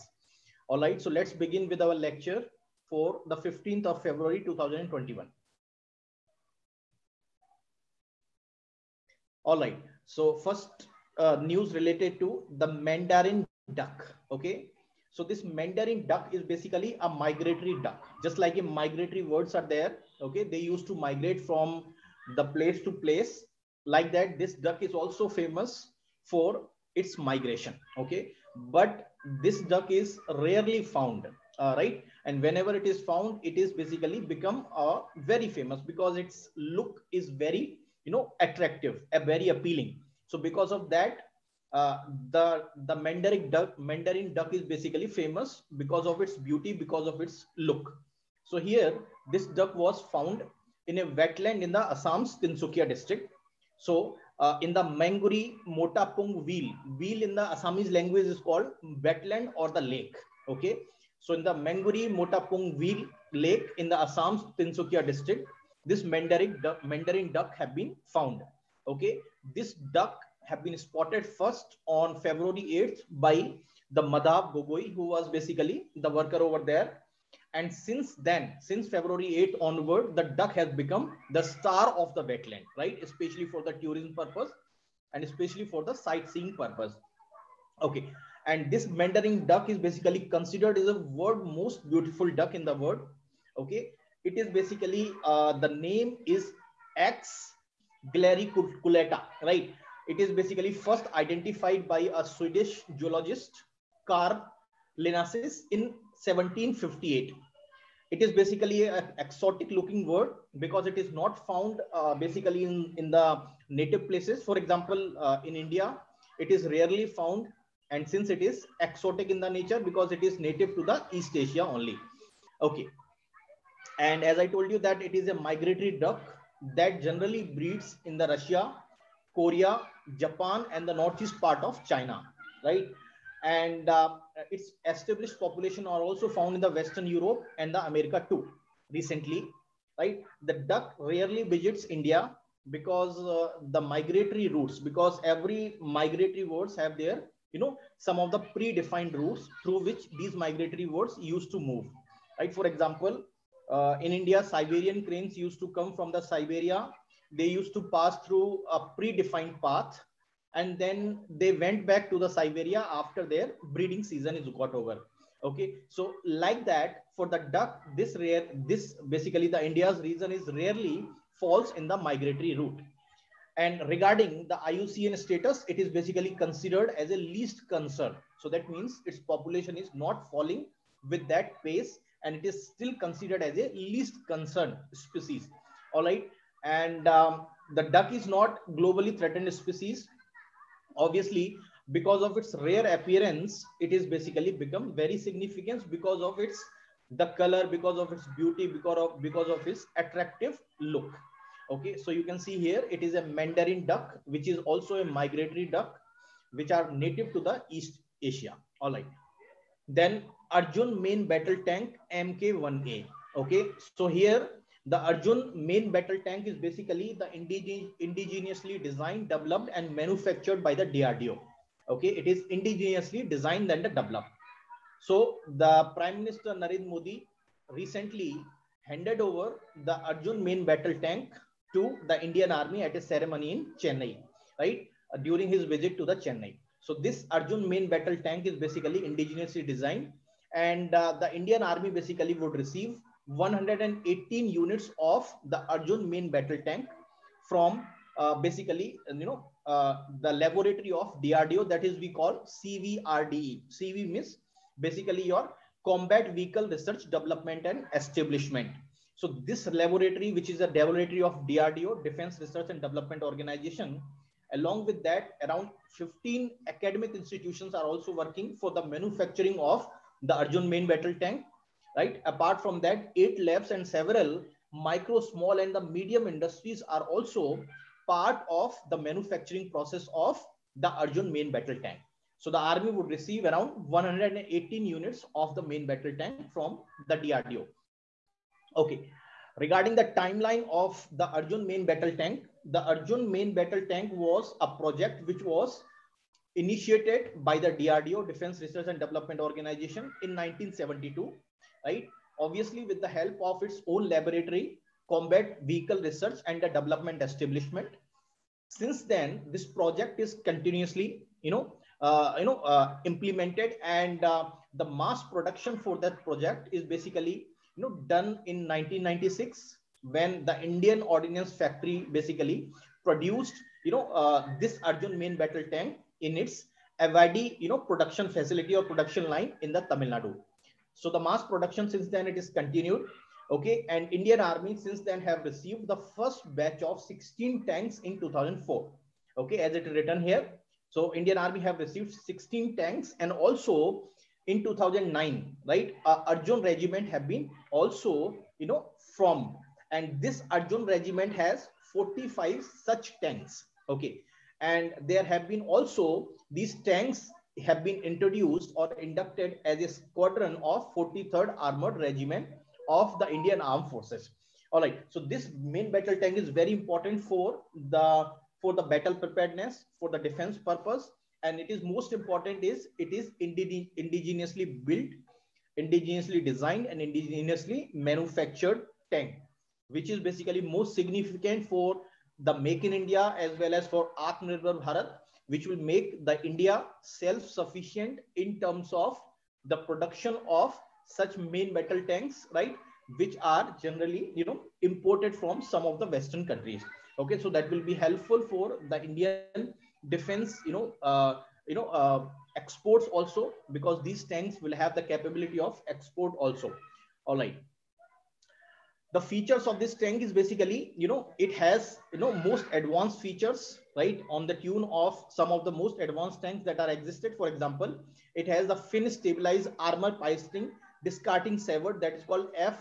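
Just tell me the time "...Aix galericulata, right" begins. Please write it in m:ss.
1:36.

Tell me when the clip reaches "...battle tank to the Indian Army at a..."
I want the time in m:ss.
3:50.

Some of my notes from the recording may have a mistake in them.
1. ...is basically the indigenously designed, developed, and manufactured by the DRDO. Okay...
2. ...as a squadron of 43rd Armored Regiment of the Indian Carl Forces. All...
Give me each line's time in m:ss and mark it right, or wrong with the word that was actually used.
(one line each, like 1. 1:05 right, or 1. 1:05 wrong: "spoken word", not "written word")
1. 3:36 right
2. 5:59 wrong: "Armed", not "Carl".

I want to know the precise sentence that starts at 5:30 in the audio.
So the mass production since then it is continued.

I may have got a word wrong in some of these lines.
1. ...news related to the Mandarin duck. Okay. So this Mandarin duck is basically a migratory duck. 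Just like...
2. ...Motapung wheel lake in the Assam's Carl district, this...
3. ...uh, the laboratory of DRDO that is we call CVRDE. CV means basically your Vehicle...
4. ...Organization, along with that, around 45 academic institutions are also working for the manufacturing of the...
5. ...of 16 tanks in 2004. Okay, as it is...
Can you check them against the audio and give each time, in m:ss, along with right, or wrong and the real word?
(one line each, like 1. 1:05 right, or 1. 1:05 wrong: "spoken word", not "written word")
1. 0:11 right
2. 1:02 wrong: "Tinsukia", not "Carl"
3. 4:09 wrong: "Combat", not "Vehicle"
4. 4:23 wrong: "15", not "45"
5. 5:36 right.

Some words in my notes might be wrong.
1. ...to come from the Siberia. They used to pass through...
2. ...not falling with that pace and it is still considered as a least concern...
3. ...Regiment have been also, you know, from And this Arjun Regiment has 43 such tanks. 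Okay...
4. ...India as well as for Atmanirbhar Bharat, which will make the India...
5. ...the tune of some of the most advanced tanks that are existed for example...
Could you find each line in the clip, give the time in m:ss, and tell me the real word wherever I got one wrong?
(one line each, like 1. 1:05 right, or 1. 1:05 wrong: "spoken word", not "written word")
1. 2:35 right
2. 2:59 right
3. 5:46 wrong: "45", not "43"
4. 6:22 right
5. 6:54 right.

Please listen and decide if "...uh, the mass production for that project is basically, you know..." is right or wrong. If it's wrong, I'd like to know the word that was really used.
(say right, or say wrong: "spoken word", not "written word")
right.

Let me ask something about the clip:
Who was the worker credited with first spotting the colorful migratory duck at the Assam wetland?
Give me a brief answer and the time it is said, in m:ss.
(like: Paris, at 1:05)
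Madhav Gogoi, at 1:14.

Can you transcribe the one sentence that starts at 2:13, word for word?
And uh, its established population are also found in the Western Europe and the America too, recently, right?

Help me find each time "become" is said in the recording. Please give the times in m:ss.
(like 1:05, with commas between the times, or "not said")
0:34, 1:20, 3:14.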